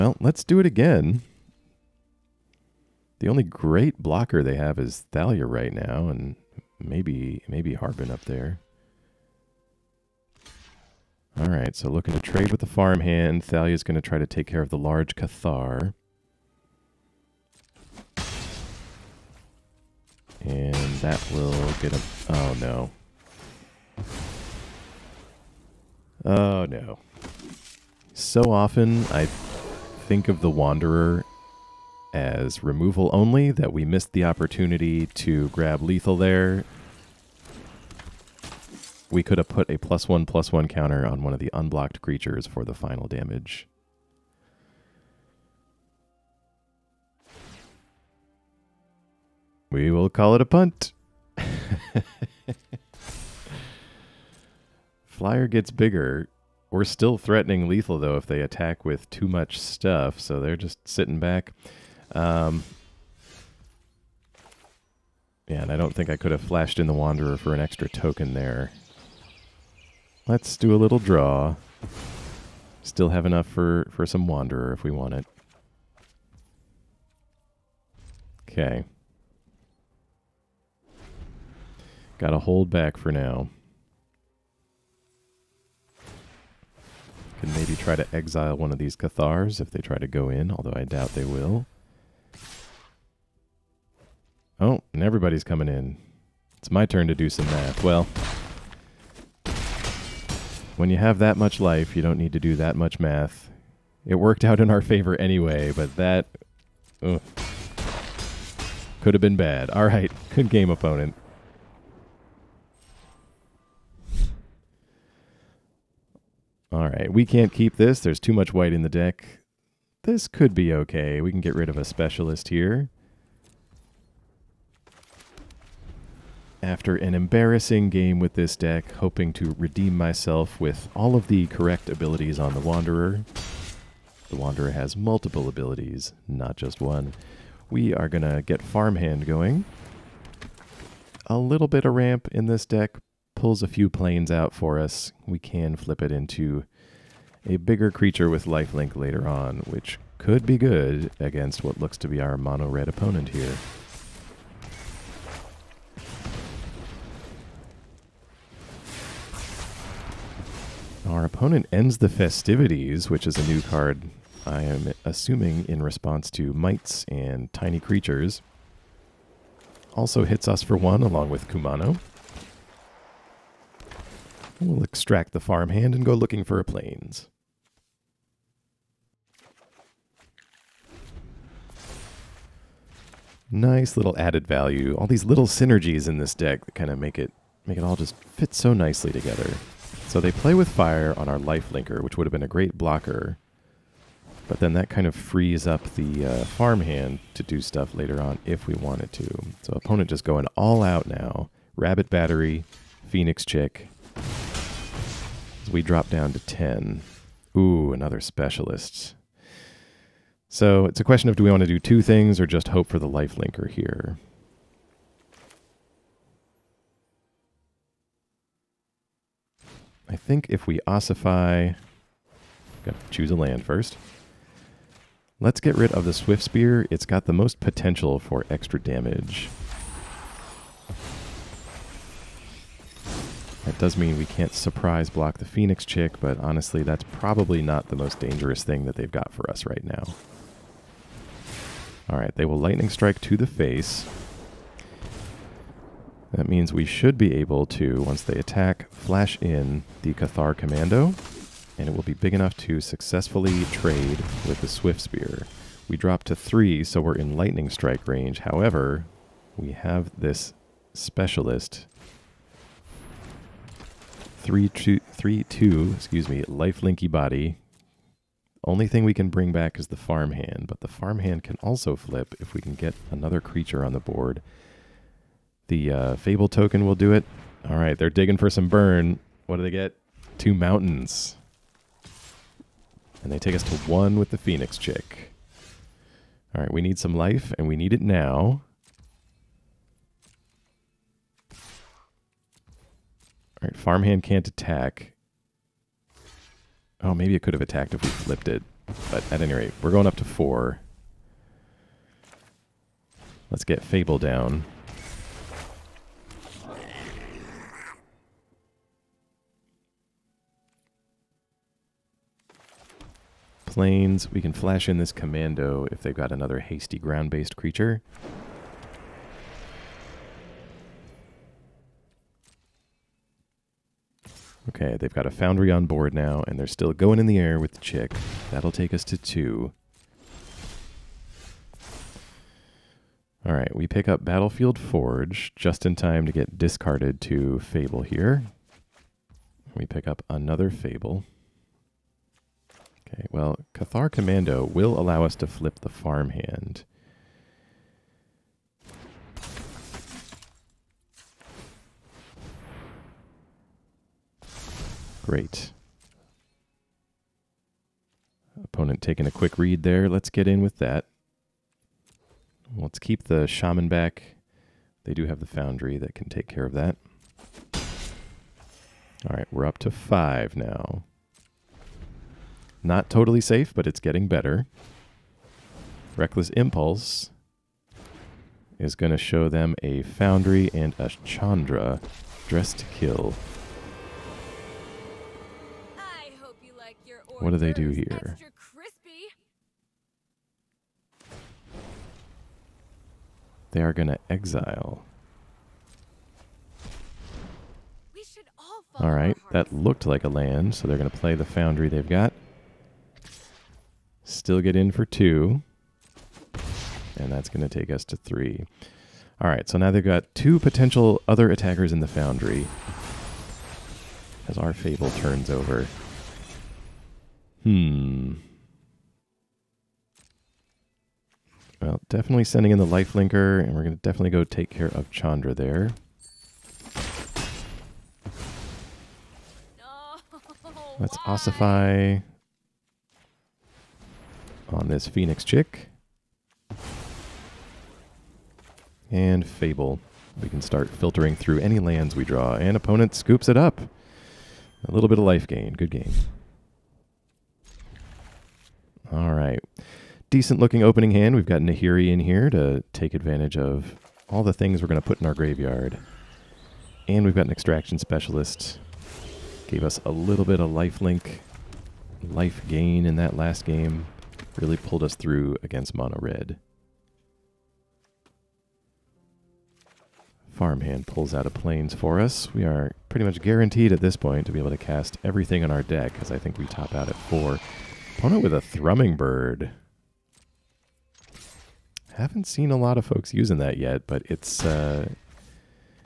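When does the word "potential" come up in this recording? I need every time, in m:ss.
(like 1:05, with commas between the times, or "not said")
3:47, 6:50.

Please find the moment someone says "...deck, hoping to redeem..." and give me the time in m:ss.
2:08.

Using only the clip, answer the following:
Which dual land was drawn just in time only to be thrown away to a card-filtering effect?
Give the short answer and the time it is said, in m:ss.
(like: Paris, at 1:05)
Battlefield Forge, at 5:34.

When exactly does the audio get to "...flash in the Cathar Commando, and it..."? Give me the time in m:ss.
4:08.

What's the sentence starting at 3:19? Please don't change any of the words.
So opponent just going all out now.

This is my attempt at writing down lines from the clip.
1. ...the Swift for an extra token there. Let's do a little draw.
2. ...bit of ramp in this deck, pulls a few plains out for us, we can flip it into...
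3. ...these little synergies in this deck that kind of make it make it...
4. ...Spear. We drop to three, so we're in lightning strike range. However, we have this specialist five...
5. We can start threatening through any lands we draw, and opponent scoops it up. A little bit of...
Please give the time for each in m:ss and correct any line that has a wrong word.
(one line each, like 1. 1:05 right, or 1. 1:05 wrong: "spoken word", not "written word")
1. 1:06 wrong: "Wanderer", not "Swift"
2. 2:21 right
3. 3:05 right
4. 4:14 wrong: "three", not "five"
5. 7:20 wrong: "filtering", not "threatening".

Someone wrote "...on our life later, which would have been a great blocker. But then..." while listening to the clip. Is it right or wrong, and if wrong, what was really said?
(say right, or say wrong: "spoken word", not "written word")
wrong: "linker", not "later".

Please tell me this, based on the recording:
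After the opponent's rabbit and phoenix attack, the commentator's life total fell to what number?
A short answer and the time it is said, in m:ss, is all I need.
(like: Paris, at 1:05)
10, at 3:26.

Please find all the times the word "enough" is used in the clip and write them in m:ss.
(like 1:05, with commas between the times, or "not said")
1:13, 4:12.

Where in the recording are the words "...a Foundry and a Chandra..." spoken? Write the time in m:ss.
6:19.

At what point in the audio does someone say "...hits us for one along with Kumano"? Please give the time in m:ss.
2:50.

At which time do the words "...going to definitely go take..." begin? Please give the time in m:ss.
7:03.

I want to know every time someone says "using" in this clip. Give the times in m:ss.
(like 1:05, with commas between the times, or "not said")
8:03.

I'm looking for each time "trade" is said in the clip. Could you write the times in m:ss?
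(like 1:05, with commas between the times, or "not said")
0:12, 4:13.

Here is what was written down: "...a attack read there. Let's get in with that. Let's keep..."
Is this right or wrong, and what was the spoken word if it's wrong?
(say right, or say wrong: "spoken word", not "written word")
wrong: "quick", not "attack".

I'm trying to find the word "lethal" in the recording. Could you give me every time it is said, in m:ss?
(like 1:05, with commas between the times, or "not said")
0:35, 0:57.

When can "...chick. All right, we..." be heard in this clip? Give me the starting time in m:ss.
4:44.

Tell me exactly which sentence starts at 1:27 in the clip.
Can maybe try to exile one of these Cathars if they try to go in, although I doubt they will.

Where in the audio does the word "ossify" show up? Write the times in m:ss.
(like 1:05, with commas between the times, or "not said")
3:40, 7:11.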